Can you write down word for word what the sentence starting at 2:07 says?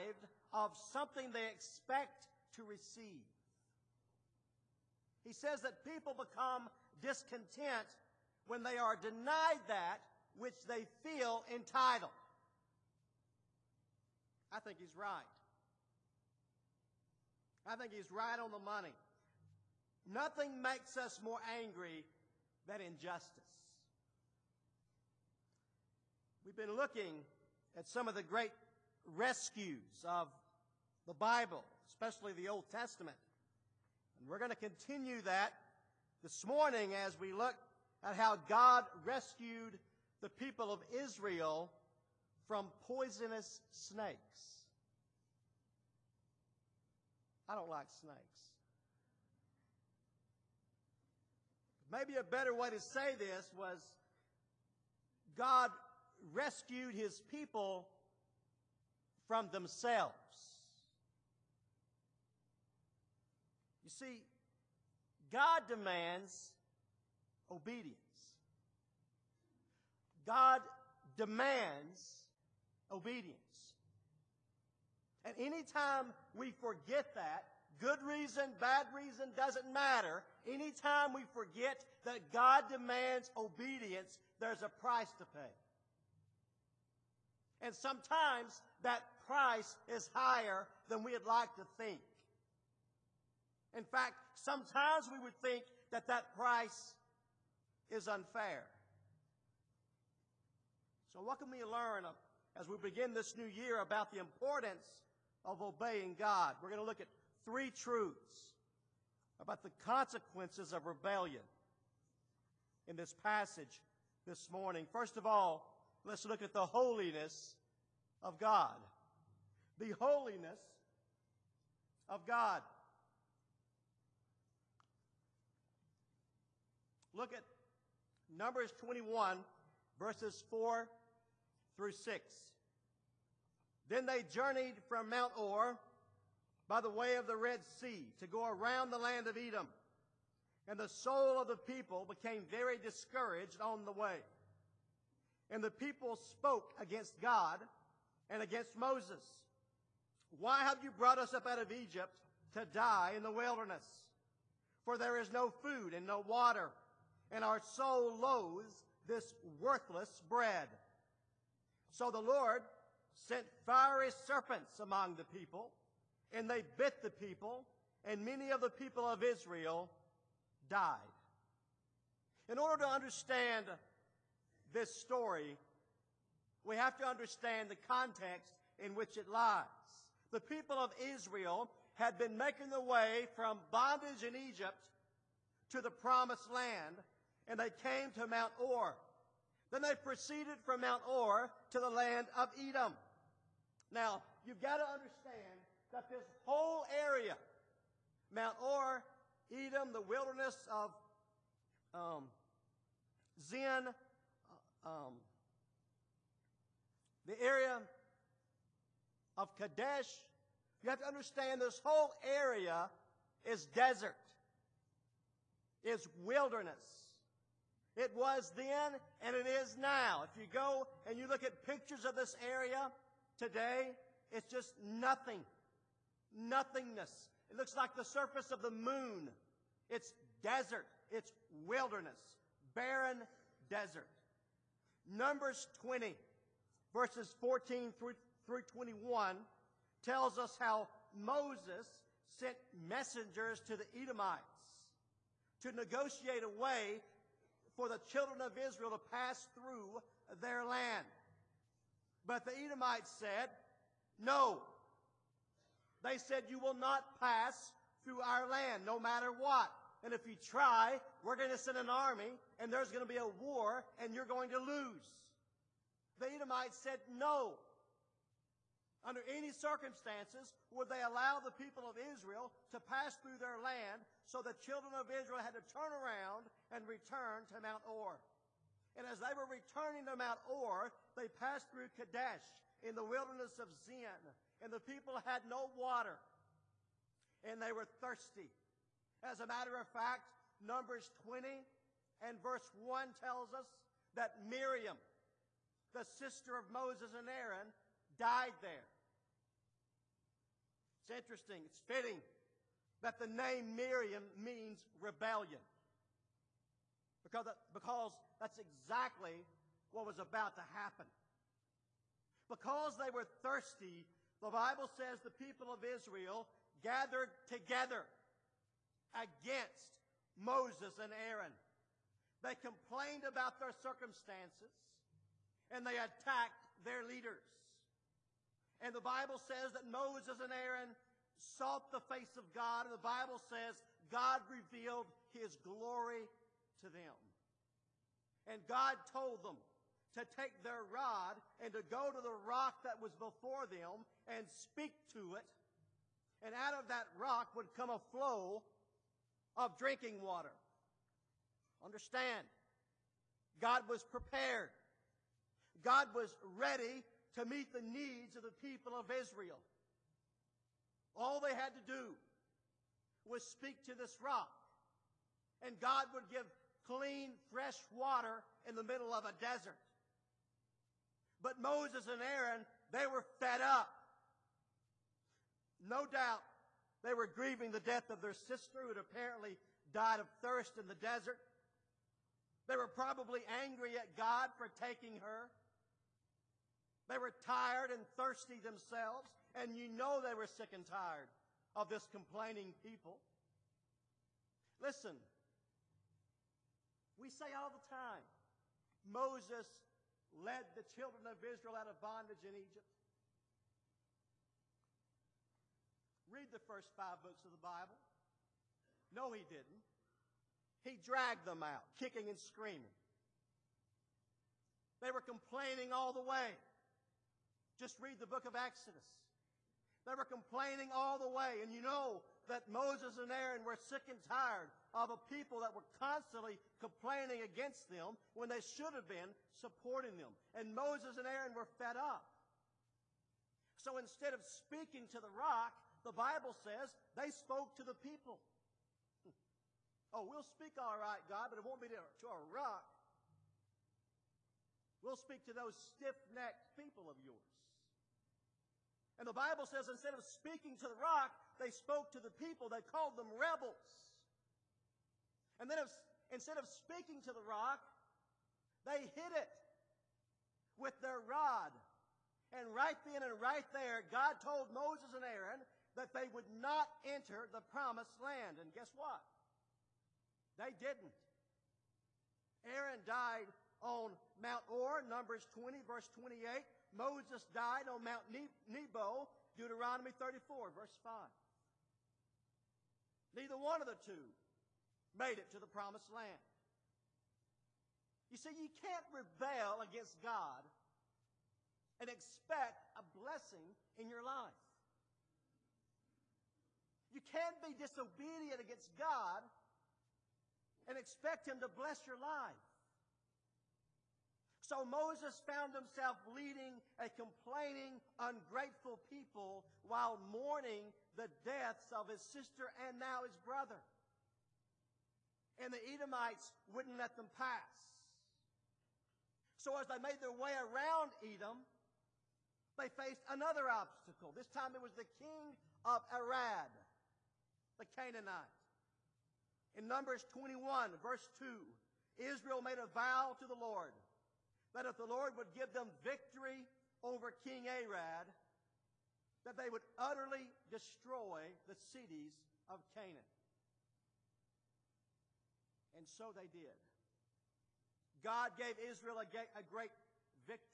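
Look at Numbers 21, verses 4 through 6.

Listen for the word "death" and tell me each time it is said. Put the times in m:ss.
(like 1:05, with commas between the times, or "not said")
6:17, 8:31.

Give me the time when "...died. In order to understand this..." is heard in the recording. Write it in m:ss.
2:50.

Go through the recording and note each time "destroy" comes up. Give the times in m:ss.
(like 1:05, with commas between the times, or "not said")
9:00.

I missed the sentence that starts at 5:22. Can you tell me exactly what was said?
They complained about their circumstances and they attacked their leaders.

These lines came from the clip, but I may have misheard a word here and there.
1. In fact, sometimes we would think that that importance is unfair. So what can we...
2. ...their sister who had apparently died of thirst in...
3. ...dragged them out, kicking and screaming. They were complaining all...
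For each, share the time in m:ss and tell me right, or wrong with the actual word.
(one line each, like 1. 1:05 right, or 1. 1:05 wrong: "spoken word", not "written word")
1. 1:33 wrong: "price", not "importance"
2. 6:18 right
3. 6:51 right.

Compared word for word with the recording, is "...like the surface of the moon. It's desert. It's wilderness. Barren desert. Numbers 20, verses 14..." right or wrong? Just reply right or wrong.
right.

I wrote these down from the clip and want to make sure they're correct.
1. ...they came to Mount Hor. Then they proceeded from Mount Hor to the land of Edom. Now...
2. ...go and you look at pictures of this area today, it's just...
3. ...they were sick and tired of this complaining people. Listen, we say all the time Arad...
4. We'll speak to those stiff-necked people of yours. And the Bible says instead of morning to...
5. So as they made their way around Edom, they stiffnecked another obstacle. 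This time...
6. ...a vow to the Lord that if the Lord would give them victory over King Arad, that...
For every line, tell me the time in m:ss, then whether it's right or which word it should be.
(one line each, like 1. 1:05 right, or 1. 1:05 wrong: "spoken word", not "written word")
1. 3:07 right
2. 3:40 right
3. 6:30 wrong: "Moses", not "Arad"
4. 7:25 wrong: "speaking", not "morning"
5. 8:39 wrong: "faced", not "stiffnecked"
6. 8:52 right.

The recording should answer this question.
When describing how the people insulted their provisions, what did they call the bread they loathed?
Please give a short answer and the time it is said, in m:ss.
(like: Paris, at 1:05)
Worthless bread, at 2:39.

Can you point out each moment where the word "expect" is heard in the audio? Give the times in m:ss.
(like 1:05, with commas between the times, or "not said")
0:01, 8:12, 8:20.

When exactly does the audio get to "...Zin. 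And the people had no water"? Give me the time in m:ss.
4:43.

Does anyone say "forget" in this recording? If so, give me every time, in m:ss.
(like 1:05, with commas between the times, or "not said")
1:16, 1:21.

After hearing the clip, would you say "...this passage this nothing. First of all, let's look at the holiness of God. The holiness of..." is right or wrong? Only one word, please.
wrong.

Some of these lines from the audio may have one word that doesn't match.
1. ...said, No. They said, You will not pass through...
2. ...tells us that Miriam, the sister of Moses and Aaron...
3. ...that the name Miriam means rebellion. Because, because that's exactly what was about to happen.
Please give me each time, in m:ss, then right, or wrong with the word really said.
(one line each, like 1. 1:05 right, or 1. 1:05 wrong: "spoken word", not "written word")
1. 4:13 right
2. 4:53 right
3. 5:03 right.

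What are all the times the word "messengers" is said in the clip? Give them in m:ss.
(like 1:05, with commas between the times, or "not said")
4:02.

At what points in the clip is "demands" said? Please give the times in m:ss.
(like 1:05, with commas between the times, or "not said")
1:05, 1:11, 1:22.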